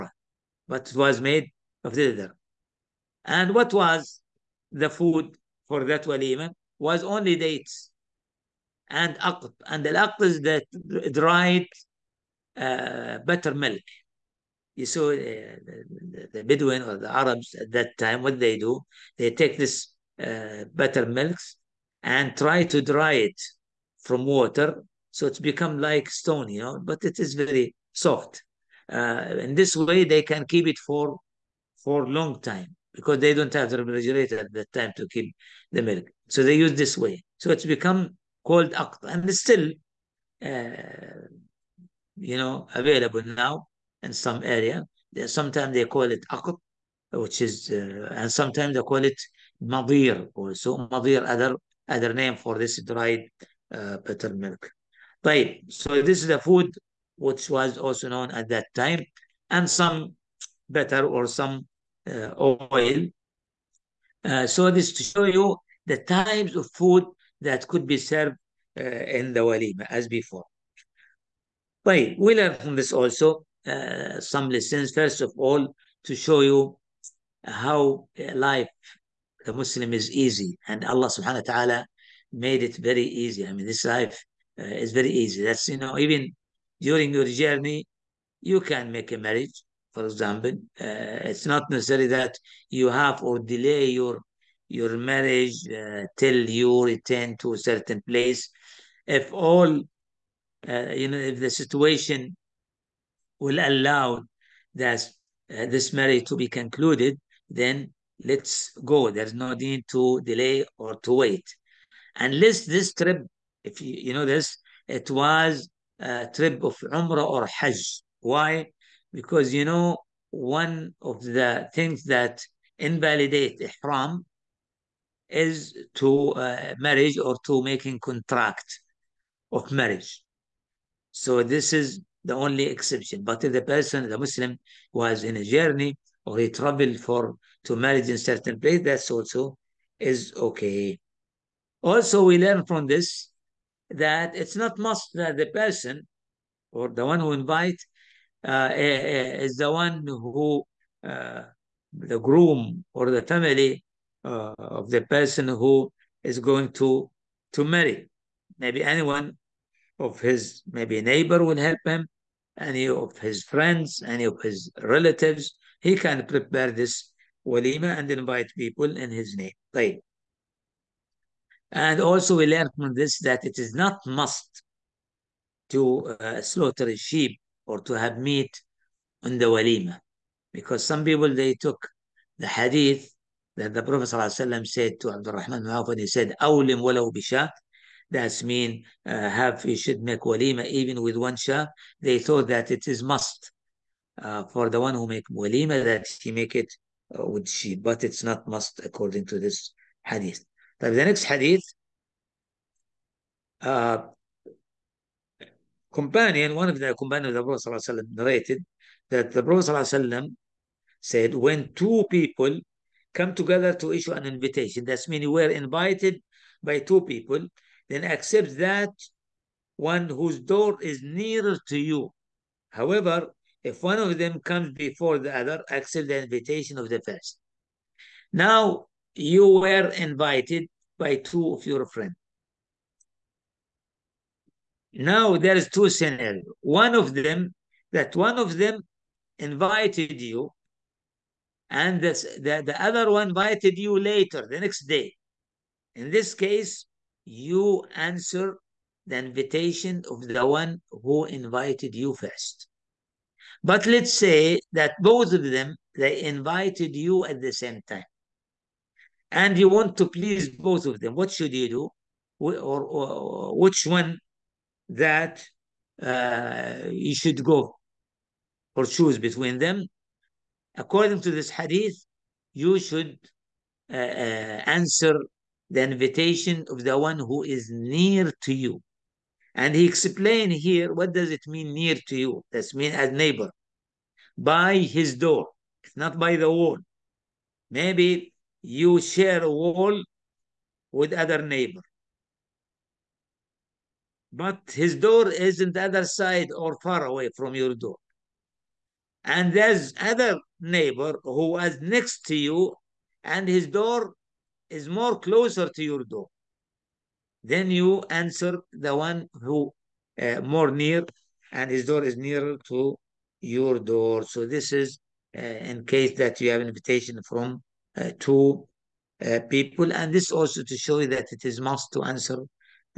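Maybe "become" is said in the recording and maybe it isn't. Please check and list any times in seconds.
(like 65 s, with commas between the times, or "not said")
25 s, 37 s.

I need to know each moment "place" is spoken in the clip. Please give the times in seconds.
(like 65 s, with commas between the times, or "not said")
98 s, 138 s.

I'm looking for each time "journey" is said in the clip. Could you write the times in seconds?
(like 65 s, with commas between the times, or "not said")
87 s, 135 s.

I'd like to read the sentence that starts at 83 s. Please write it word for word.
I mean, this life uh, is very easy.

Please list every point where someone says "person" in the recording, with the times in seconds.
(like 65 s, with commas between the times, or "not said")
133 s, 145 s, 155 s.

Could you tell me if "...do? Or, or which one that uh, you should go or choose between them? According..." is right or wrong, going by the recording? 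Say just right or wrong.
right.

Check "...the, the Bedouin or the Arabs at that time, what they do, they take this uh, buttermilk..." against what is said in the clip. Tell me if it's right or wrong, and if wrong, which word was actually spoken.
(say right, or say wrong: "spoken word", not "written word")
right.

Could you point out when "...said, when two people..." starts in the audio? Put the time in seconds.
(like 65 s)
211 s.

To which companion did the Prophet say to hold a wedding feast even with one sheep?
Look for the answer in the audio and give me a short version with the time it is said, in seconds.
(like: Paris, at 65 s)
Abdul Rahman bin Awf, at 185 s.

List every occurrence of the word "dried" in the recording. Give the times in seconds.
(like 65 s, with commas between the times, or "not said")
11 s, 52 s.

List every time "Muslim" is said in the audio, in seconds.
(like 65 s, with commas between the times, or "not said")
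79 s, 134 s.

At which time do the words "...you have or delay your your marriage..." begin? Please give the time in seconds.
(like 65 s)
92 s.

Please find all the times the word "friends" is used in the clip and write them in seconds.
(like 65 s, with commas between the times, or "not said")
163 s, 231 s.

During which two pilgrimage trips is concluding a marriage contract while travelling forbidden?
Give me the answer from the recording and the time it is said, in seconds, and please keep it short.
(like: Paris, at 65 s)
Umrah or Hajj, at 116 s.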